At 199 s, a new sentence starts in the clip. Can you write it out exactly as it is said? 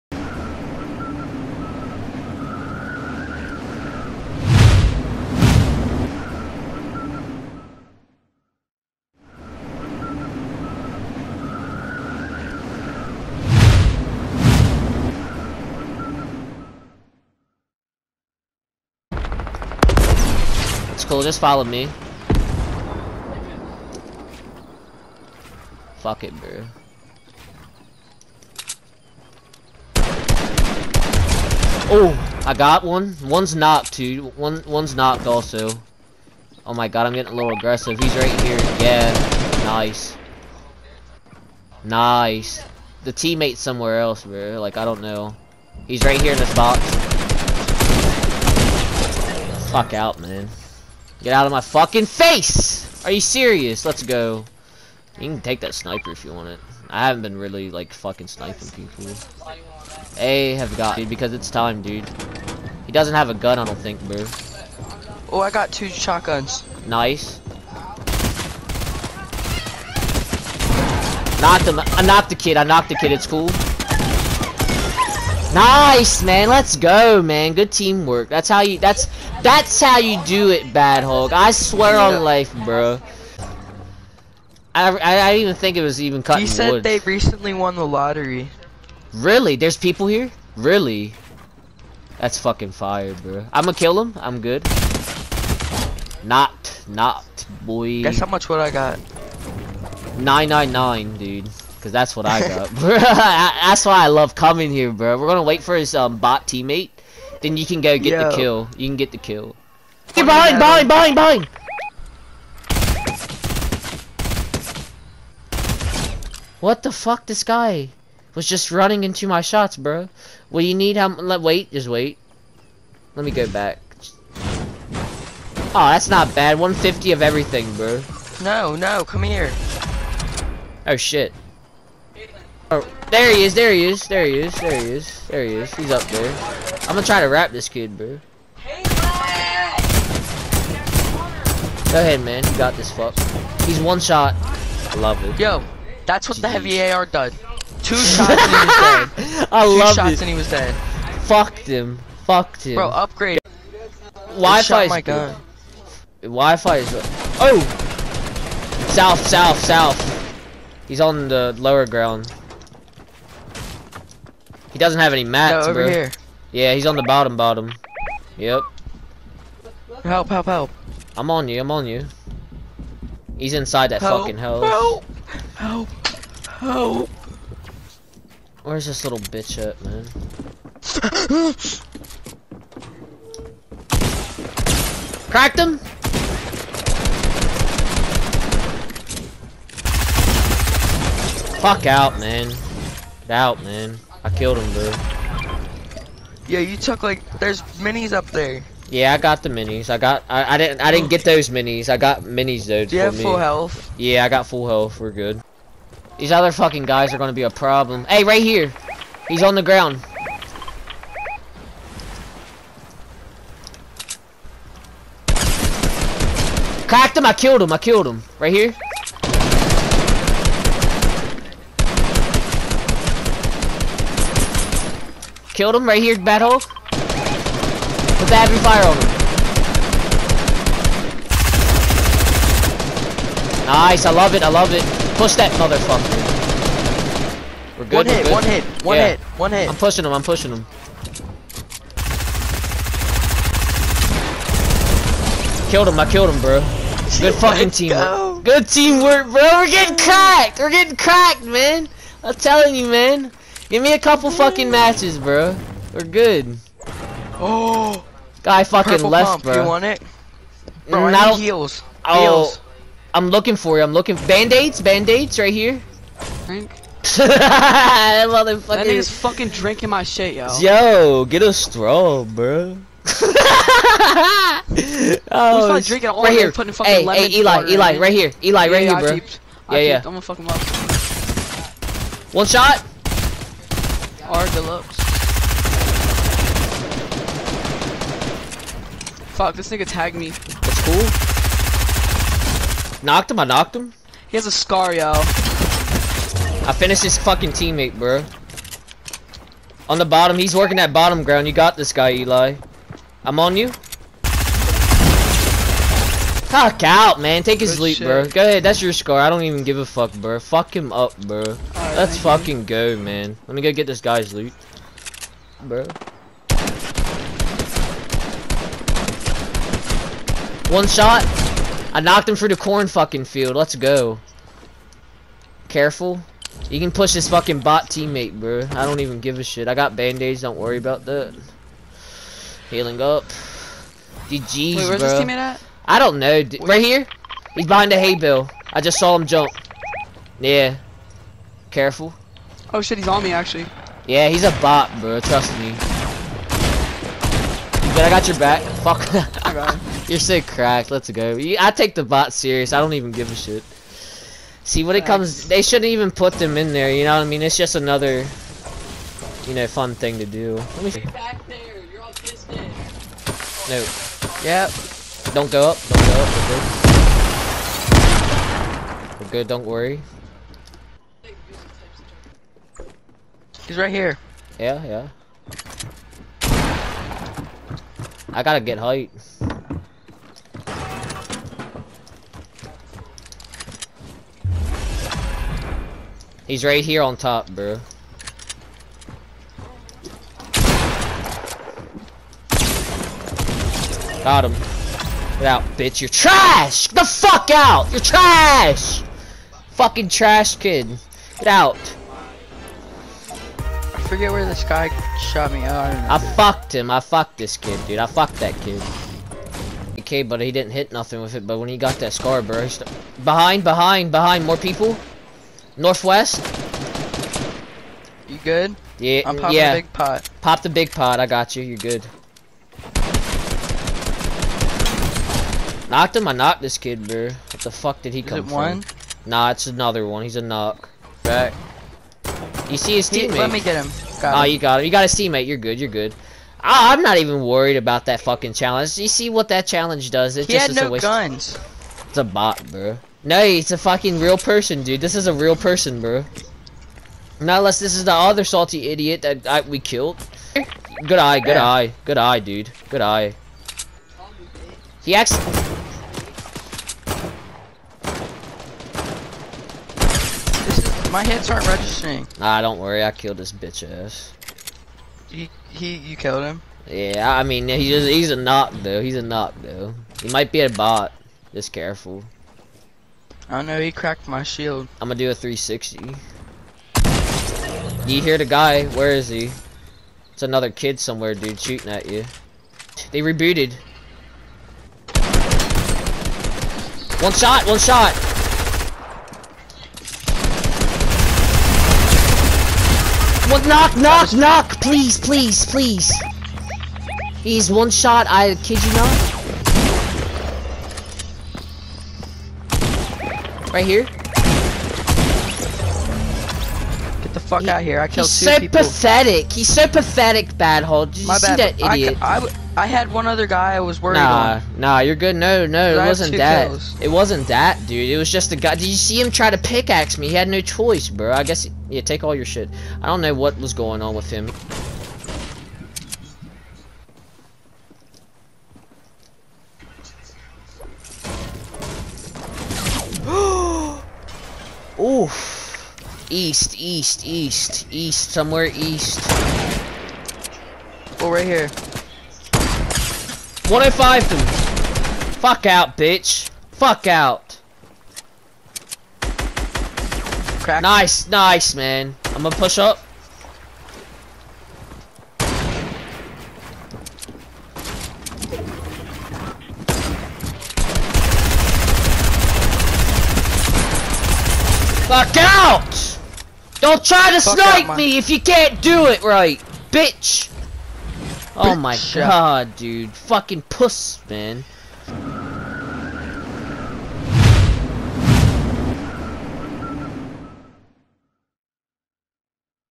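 I got I, I didn't I didn't get those minis.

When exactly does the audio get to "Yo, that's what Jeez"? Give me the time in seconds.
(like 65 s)
145 s.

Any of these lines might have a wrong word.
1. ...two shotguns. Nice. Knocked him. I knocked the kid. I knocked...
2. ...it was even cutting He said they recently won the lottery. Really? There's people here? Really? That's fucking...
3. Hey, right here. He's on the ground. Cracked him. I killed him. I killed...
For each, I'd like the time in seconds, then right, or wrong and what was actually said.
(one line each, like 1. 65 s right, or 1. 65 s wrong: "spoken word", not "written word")
1. 65 s right
2. 85 s right
3. 208 s right.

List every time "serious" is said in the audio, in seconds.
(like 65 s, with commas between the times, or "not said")
53 s, 352 s.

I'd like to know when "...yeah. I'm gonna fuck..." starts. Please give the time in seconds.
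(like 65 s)
279 s.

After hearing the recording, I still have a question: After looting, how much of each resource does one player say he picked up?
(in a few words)
150.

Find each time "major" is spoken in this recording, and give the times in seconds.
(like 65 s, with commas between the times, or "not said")
not said.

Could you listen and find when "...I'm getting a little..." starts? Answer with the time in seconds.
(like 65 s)
37 s.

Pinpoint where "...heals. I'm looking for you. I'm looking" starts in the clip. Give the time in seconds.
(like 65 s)
262 s.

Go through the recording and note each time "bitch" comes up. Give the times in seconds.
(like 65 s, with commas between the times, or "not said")
179 s, 395 s, 463 s, 545 s, 569 s.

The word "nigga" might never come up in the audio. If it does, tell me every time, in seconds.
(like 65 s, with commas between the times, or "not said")
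268 s, 289 s.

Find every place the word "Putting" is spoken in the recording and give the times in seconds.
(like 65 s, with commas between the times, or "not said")
276 s.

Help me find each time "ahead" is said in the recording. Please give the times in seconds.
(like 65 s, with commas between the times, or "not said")
141 s, 308 s.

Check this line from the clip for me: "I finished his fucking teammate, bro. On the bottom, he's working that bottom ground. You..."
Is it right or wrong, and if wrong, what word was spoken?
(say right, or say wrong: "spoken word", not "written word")
right.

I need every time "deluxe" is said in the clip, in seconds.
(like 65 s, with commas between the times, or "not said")
284 s.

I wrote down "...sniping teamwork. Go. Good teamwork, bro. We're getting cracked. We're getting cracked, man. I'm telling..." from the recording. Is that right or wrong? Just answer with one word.
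wrong.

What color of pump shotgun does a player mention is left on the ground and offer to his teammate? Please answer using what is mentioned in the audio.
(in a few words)
Purple.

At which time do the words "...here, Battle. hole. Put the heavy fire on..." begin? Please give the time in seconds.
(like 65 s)
226 s.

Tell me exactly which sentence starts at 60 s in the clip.
A have got dude, because it's time, dude.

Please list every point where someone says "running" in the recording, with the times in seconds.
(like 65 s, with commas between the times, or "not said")
118 s.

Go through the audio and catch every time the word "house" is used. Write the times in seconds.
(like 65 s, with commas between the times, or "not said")
174 s.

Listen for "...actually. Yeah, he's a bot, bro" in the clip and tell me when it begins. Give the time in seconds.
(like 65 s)
343 s.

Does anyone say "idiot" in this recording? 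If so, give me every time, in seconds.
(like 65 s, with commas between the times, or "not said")
448 s, 511 s.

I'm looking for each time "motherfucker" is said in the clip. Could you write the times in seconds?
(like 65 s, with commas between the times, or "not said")
235 s, 268 s.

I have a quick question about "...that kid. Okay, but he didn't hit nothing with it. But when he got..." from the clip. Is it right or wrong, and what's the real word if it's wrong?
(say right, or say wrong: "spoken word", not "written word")
right.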